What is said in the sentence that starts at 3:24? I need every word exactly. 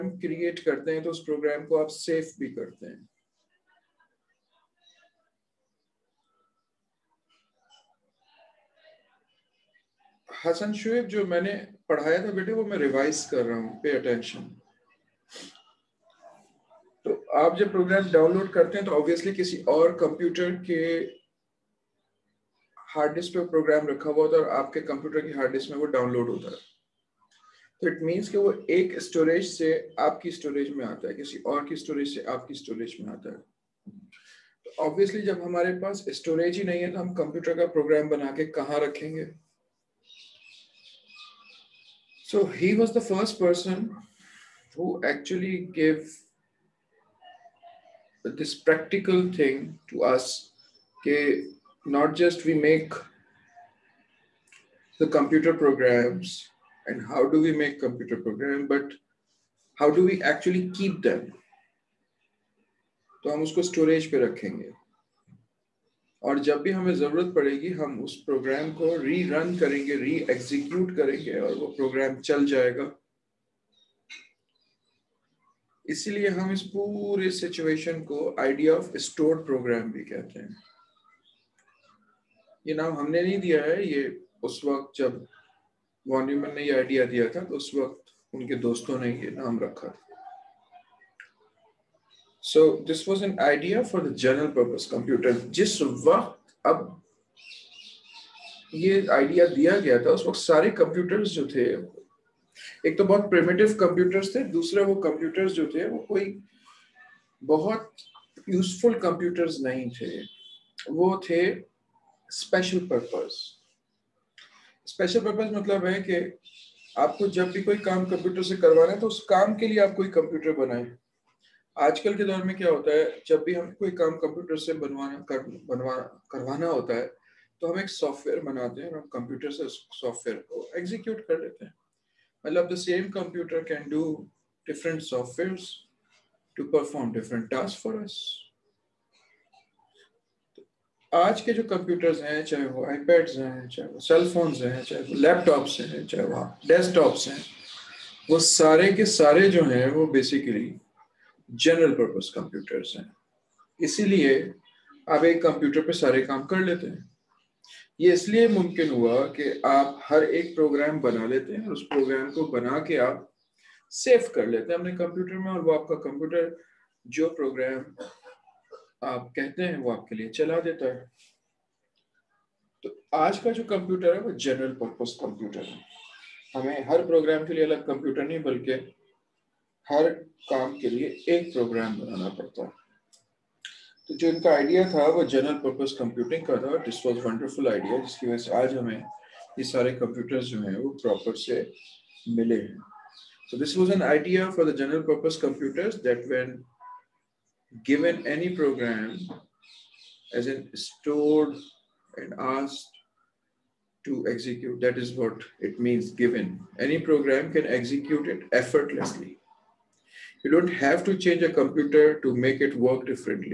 That is what it means given.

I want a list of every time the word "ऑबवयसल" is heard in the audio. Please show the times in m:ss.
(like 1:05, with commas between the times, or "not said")
0:18, 0:34.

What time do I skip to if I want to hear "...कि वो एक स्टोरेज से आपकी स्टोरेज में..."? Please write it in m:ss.
0:28.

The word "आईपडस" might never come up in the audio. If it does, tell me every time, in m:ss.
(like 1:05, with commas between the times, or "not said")
2:22.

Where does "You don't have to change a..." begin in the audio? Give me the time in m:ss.
3:30.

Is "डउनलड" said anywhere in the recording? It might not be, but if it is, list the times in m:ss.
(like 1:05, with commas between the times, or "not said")
0:18, 0:25.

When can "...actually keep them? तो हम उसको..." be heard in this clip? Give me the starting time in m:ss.
1:00.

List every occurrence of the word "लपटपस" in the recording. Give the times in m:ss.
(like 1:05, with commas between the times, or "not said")
2:25.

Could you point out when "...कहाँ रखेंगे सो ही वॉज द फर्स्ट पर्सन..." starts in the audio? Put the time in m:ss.
0:38.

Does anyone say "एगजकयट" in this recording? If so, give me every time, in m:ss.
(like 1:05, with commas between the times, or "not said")
1:10, 2:10.